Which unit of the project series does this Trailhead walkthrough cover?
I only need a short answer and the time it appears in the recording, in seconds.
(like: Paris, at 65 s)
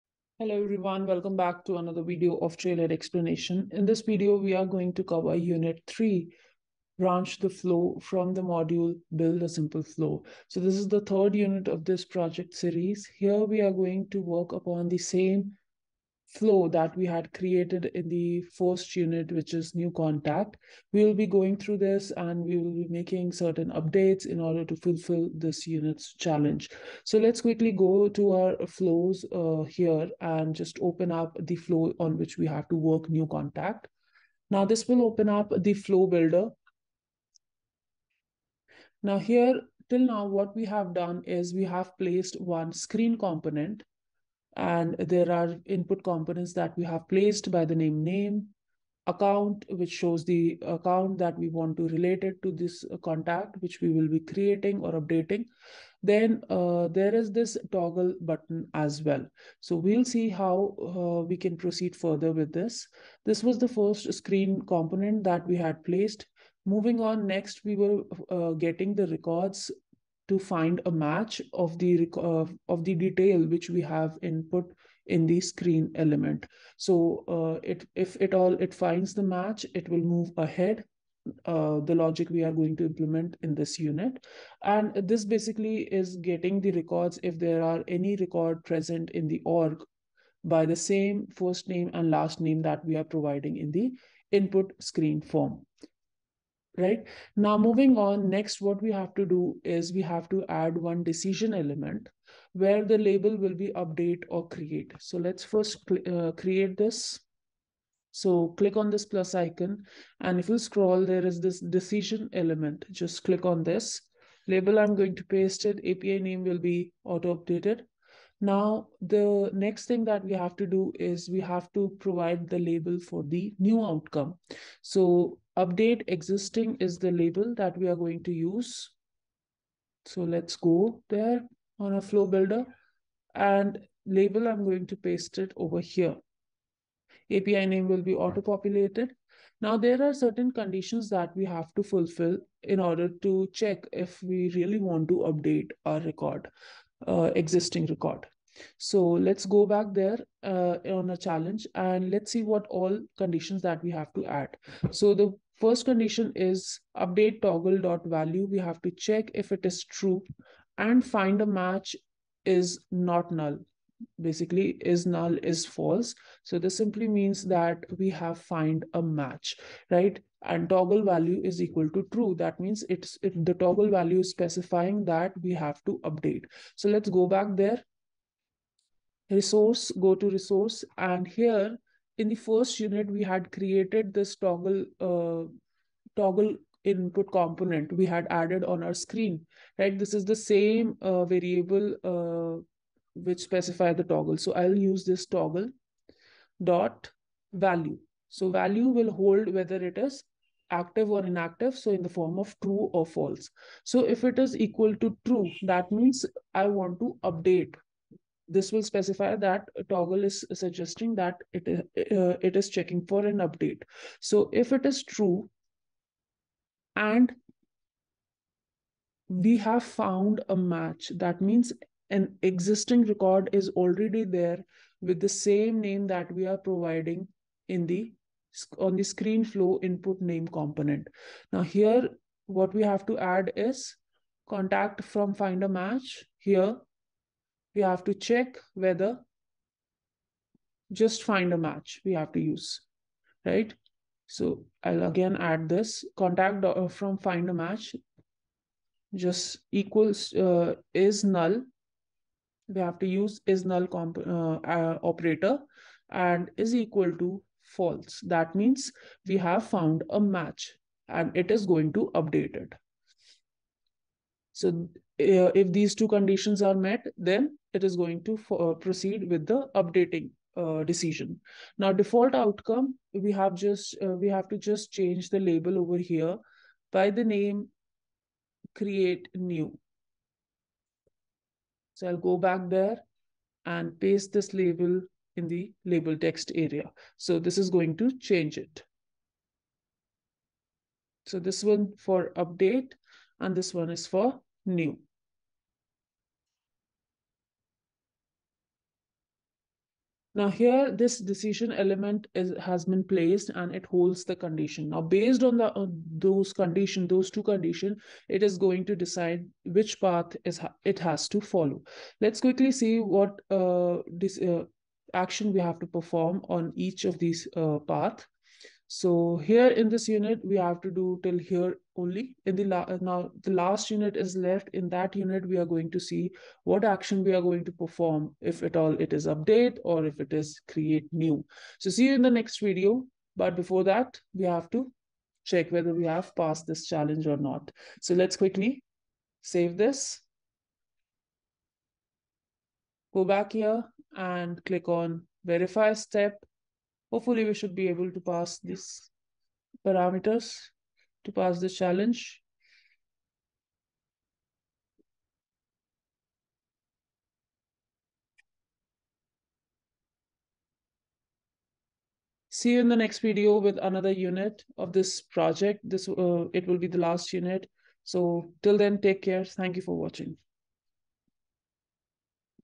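Unit 3, at 5 s.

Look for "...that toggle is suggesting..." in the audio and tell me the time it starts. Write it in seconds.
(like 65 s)
209 s.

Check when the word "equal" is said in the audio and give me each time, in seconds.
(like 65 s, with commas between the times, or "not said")
171 s, 204 s, 249 s, 256 s.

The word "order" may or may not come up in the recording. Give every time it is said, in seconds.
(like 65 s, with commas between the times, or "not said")
24 s, 142 s.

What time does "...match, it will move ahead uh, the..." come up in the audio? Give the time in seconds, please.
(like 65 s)
79 s.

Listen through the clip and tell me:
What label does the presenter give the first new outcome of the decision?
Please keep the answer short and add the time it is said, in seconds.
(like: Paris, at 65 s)
update existing, at 125 s.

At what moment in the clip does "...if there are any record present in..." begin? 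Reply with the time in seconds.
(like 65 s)
87 s.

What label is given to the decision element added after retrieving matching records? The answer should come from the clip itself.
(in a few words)
update or create.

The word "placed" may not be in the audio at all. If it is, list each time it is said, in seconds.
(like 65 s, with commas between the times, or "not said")
41 s, 47 s, 65 s, 303 s.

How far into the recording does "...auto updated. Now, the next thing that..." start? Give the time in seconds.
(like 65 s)
117 s.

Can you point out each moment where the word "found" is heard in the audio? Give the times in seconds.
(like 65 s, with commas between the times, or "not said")
219 s, 259 s.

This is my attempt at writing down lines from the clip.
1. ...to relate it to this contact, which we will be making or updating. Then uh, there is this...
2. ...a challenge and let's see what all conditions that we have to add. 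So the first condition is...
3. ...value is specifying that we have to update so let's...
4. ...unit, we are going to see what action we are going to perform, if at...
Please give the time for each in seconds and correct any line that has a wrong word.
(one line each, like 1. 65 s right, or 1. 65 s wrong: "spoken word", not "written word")
1. 51 s wrong: "creating", not "making"
2. 151 s right
3. 173 s right
4. 325 s right.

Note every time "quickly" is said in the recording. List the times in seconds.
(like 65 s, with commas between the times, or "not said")
27 s, 312 s, 338 s.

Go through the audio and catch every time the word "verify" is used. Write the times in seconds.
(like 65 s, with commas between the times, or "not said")
345 s.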